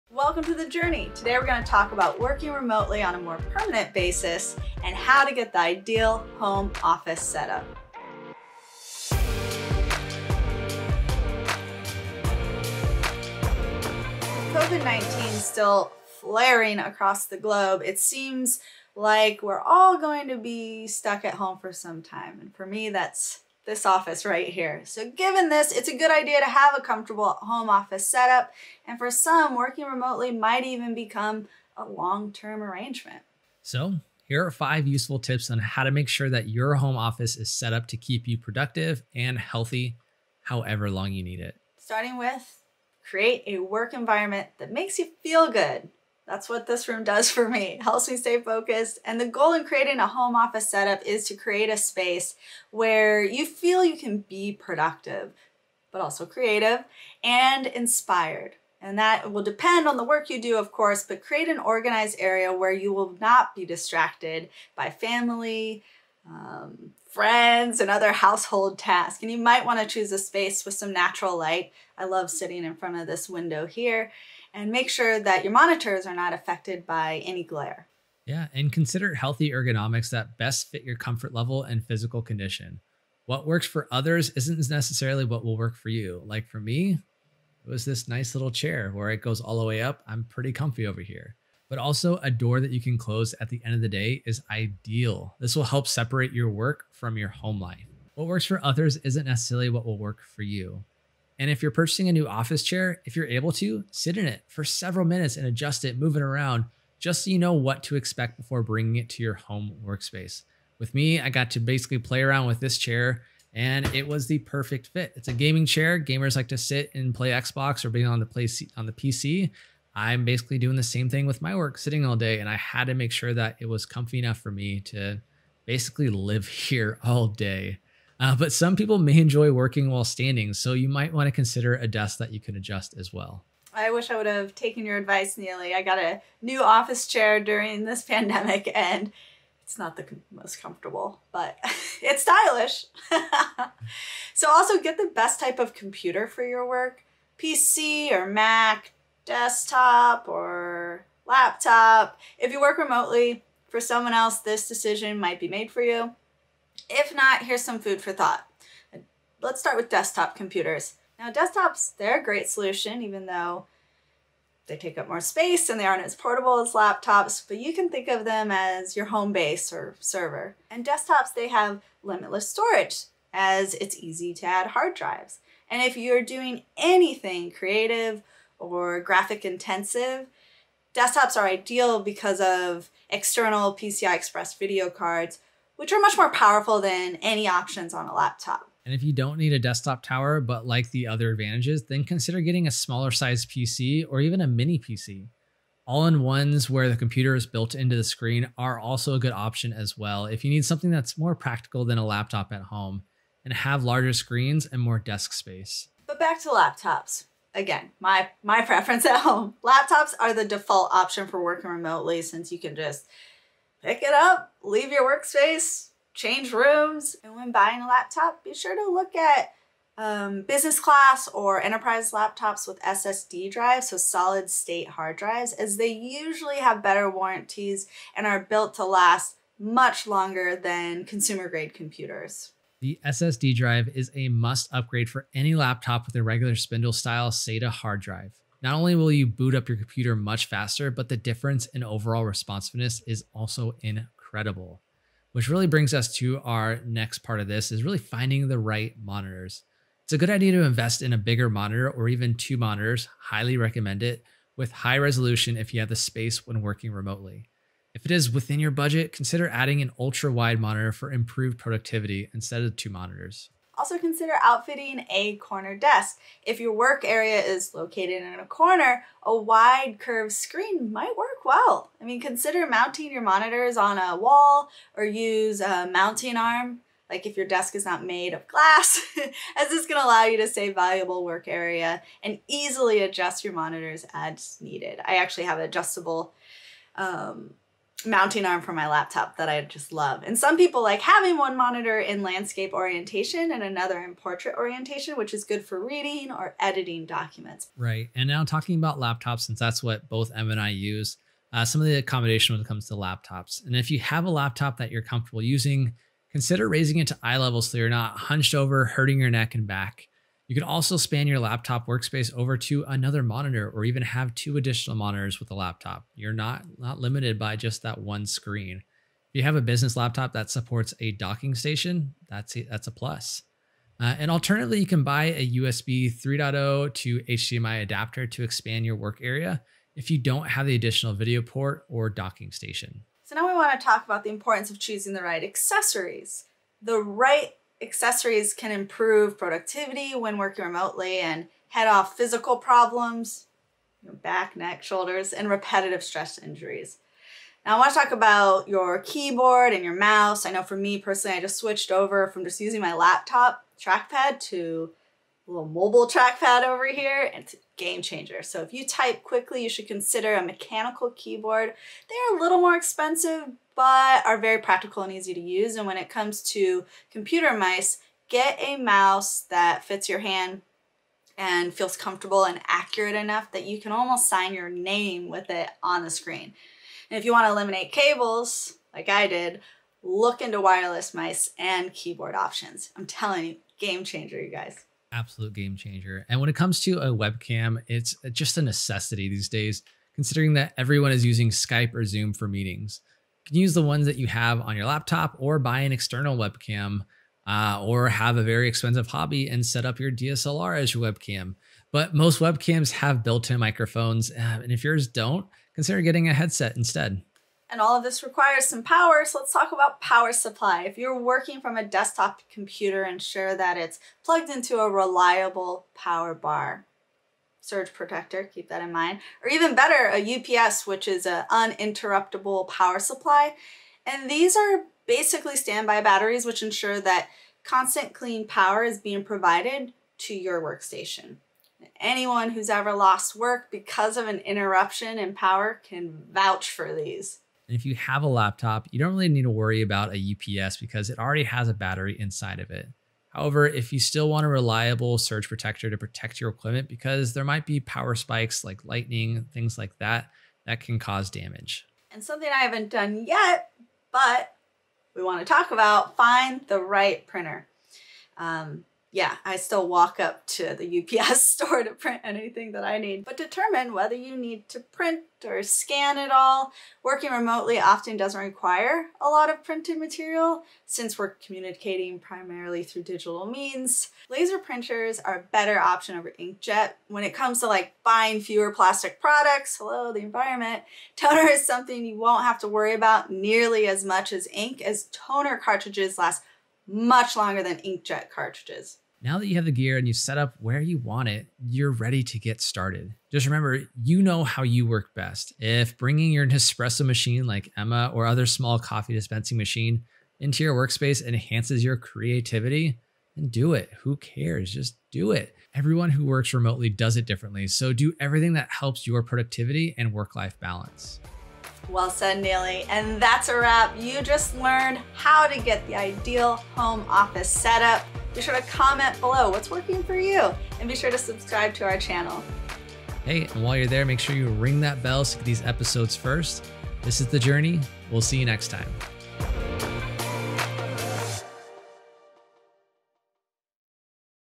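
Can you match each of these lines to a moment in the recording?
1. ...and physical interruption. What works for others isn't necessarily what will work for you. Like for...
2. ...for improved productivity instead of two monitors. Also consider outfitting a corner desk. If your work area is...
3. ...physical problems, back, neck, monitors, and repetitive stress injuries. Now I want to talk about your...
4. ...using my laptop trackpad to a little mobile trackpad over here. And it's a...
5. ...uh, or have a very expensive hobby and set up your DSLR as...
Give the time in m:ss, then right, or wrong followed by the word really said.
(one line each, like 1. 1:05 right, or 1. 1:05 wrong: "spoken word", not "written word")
1. 1:21 wrong: "condition", not "interruption"
2. 4:20 right
3. 5:42 wrong: "shoulders", not "monitors"
4. 5:52 right
5. 6:37 right.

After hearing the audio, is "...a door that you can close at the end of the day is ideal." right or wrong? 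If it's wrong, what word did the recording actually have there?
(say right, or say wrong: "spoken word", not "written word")
right.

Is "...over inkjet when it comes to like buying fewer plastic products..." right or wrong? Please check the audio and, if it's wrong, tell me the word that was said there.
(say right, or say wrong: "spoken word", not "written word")
right.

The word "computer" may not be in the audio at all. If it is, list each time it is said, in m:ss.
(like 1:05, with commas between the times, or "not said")
2:25, 2:40, 3:16, 3:51, 3:59, 6:07, 6:52.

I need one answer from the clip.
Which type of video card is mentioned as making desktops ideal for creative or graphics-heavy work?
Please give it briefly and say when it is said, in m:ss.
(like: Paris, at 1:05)
PCI Express, at 3:03.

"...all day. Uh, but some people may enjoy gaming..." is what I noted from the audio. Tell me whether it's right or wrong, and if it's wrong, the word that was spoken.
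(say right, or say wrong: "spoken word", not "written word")
wrong: "working", not "gaming".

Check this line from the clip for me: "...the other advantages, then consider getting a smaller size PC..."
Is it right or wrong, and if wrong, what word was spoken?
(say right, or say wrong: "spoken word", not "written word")
right.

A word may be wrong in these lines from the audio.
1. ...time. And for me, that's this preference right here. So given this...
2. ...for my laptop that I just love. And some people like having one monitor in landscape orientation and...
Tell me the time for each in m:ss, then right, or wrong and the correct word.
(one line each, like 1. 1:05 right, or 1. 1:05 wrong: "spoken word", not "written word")
1. 0:22 wrong: "office", not "preference"
2. 4:48 right.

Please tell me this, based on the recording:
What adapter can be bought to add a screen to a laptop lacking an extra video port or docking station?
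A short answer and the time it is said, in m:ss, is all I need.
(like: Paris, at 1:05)
USB 3.0 to HDMI, at 5:25.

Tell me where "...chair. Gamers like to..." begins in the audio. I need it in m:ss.
1:55.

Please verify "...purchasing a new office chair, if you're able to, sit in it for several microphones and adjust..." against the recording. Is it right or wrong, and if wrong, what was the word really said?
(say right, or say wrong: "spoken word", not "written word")
wrong: "minutes", not "microphones".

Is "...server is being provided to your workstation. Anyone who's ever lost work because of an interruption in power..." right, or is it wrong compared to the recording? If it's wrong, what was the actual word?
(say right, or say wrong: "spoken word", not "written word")
wrong: "power", not "server".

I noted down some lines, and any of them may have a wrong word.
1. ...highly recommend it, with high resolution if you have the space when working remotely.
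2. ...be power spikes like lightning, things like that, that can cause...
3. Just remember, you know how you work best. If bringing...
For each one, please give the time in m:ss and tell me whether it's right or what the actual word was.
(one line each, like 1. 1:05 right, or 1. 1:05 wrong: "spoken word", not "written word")
1. 4:13 right
2. 7:27 right
3. 8:13 right.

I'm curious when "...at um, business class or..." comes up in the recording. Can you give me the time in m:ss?
3:39.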